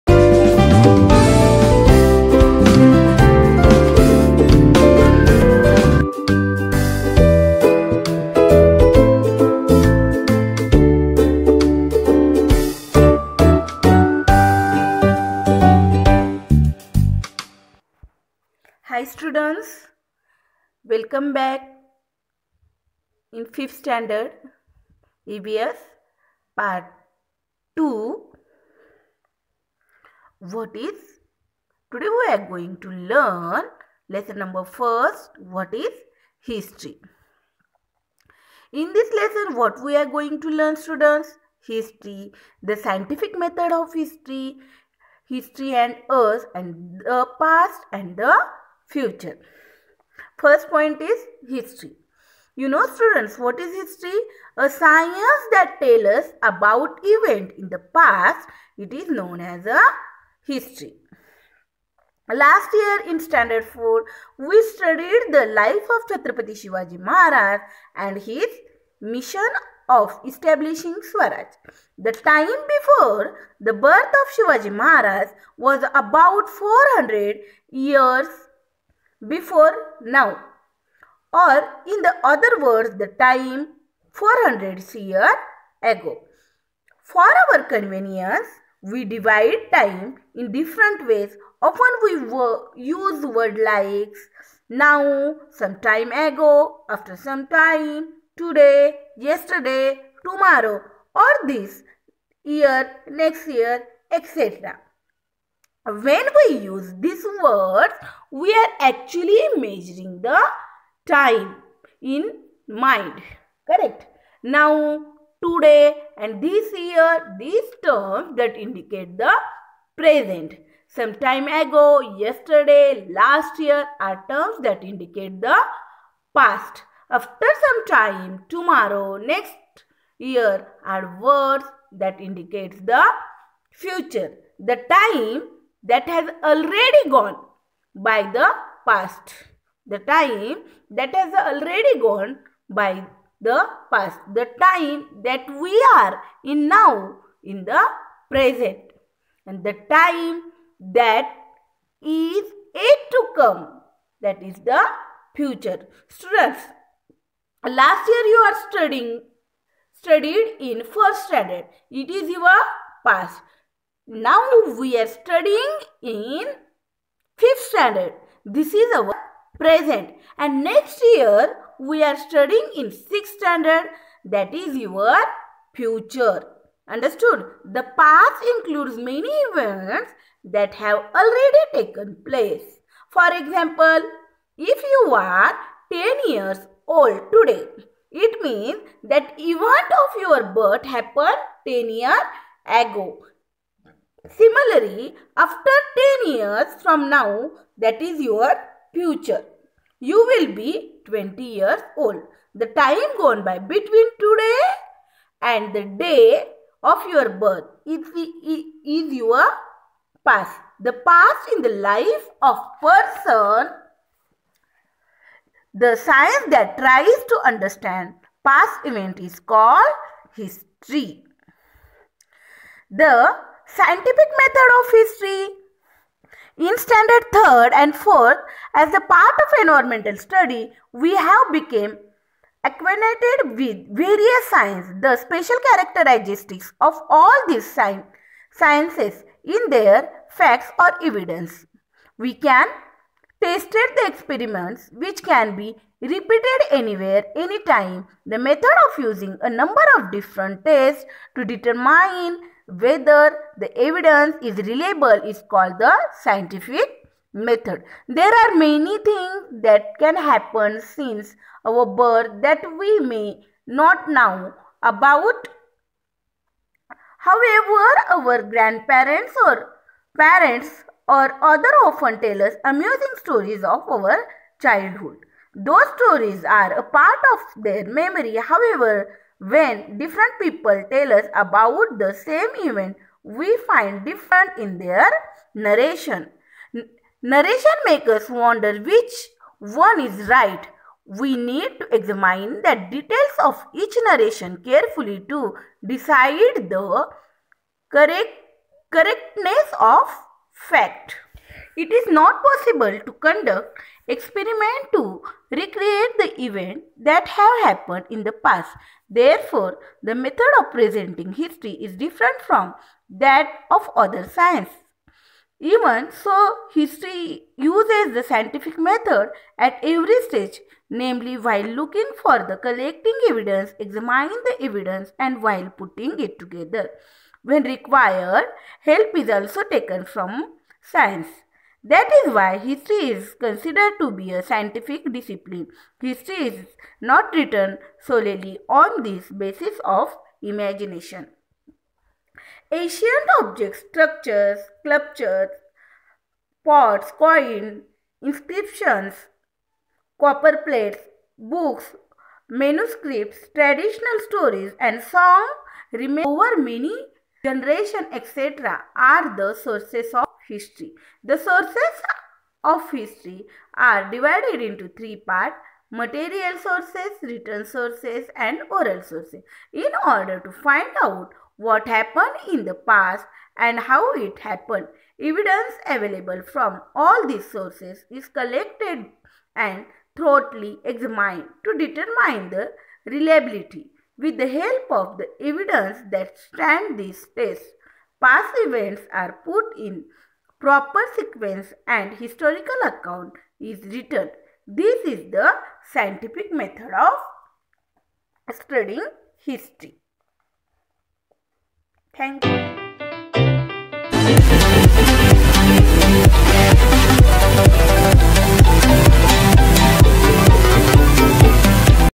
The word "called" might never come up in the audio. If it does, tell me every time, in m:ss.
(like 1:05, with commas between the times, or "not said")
3:39, 4:15.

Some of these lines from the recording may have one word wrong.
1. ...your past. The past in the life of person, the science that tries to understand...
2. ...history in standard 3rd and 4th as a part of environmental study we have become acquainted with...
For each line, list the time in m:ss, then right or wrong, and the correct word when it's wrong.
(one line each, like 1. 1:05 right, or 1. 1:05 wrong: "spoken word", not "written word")
1. 3:29 right
2. 3:44 right.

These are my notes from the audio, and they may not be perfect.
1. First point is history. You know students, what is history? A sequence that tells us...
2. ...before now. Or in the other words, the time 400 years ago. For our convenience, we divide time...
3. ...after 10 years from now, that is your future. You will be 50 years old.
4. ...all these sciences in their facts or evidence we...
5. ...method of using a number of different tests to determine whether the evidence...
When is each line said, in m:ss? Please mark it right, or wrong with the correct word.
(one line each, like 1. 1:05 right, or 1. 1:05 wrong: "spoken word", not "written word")
1. 0:50 wrong: "science", not "sequence"
2. 1:19 right
3. 3:15 wrong: "20", not "50"
4. 3:57 right
5. 4:08 right.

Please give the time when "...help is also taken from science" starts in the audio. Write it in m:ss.
5:28.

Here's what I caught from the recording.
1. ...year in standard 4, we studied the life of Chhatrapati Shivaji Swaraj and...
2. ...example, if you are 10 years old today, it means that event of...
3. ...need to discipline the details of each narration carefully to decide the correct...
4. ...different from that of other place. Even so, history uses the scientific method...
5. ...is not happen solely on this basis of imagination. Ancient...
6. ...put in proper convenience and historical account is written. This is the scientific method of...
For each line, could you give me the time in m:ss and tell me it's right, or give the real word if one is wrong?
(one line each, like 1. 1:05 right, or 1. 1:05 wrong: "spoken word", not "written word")
1. 1:02 wrong: "Maharaj", not "Swaraj"
2. 3:03 right
3. 4:51 wrong: "examine", not "discipline"
4. 5:11 wrong: "science", not "place"
5. 5:36 wrong: "written", not "happen"
6. 6:29 wrong: "sequence", not "convenience".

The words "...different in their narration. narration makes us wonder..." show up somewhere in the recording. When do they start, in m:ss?
4:44.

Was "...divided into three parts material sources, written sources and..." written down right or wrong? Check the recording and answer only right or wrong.
right.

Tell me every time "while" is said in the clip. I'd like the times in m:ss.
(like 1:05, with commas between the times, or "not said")
5:21, 5:25.